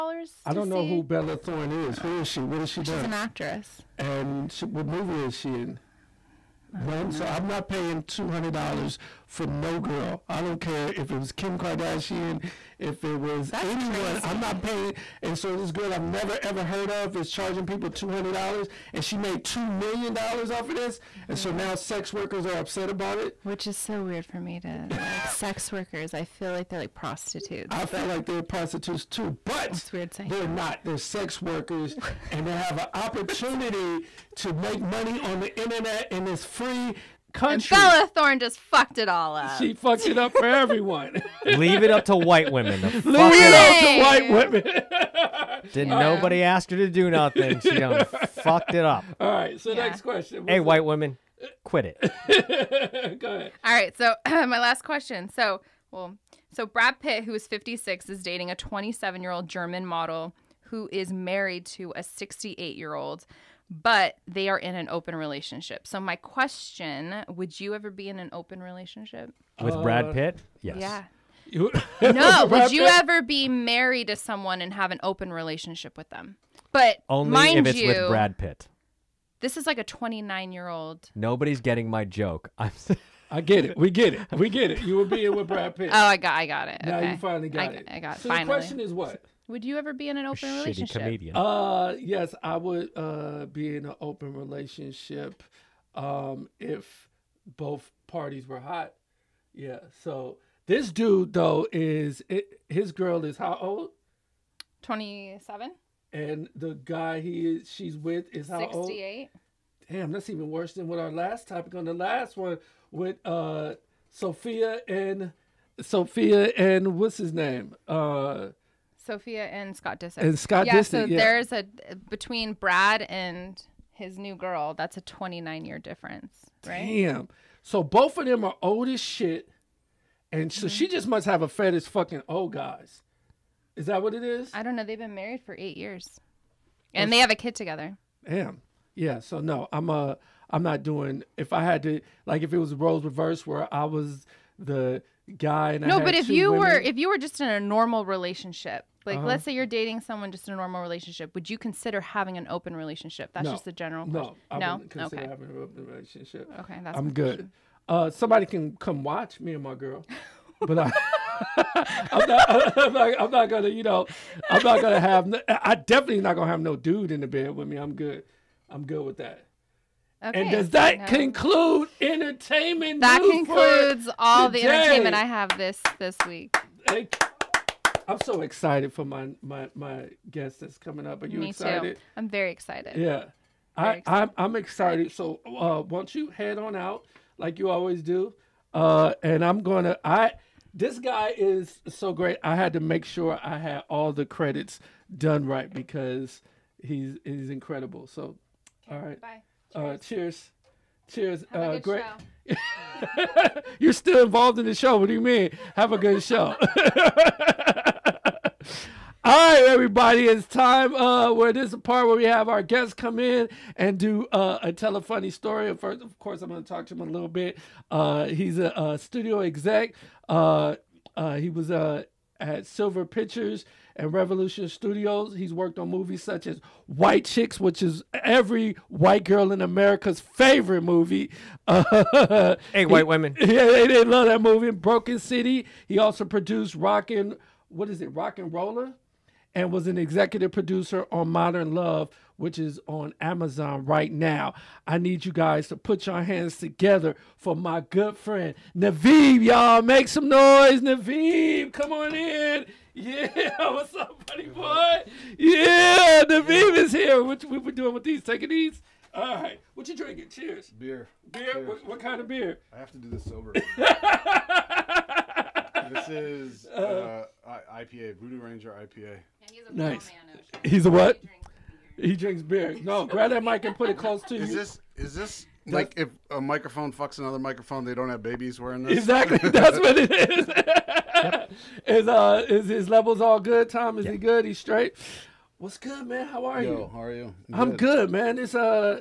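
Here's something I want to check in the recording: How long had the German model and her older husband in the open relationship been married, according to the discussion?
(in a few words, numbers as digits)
8 years.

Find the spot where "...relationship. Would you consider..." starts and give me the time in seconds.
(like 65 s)
150 s.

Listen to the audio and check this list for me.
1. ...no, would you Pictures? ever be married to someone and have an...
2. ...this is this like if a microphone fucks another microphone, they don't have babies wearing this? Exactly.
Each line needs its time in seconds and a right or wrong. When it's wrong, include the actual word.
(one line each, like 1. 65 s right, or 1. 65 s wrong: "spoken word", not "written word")
1. 72 s wrong: "Pitt", not "Pictures"
2. 274 s right.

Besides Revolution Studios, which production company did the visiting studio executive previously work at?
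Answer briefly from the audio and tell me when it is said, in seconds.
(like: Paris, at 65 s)
Silver Pictures, at 222 s.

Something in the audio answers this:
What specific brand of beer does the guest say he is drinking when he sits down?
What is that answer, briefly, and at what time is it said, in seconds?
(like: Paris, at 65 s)
Voodoo Ranger IPA, at 268 s.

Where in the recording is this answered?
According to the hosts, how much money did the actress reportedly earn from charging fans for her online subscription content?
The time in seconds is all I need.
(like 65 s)
19 s.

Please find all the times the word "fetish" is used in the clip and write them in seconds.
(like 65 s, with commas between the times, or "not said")
131 s.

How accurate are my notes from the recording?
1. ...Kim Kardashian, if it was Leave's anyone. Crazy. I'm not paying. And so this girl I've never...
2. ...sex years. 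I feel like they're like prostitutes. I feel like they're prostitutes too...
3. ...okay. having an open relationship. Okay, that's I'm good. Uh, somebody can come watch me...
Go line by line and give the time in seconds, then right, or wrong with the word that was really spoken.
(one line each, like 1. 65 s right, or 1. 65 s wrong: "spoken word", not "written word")
1. 11 s wrong: "That", not "Leave"
2. 25 s wrong: "workers", not "years"
3. 155 s right.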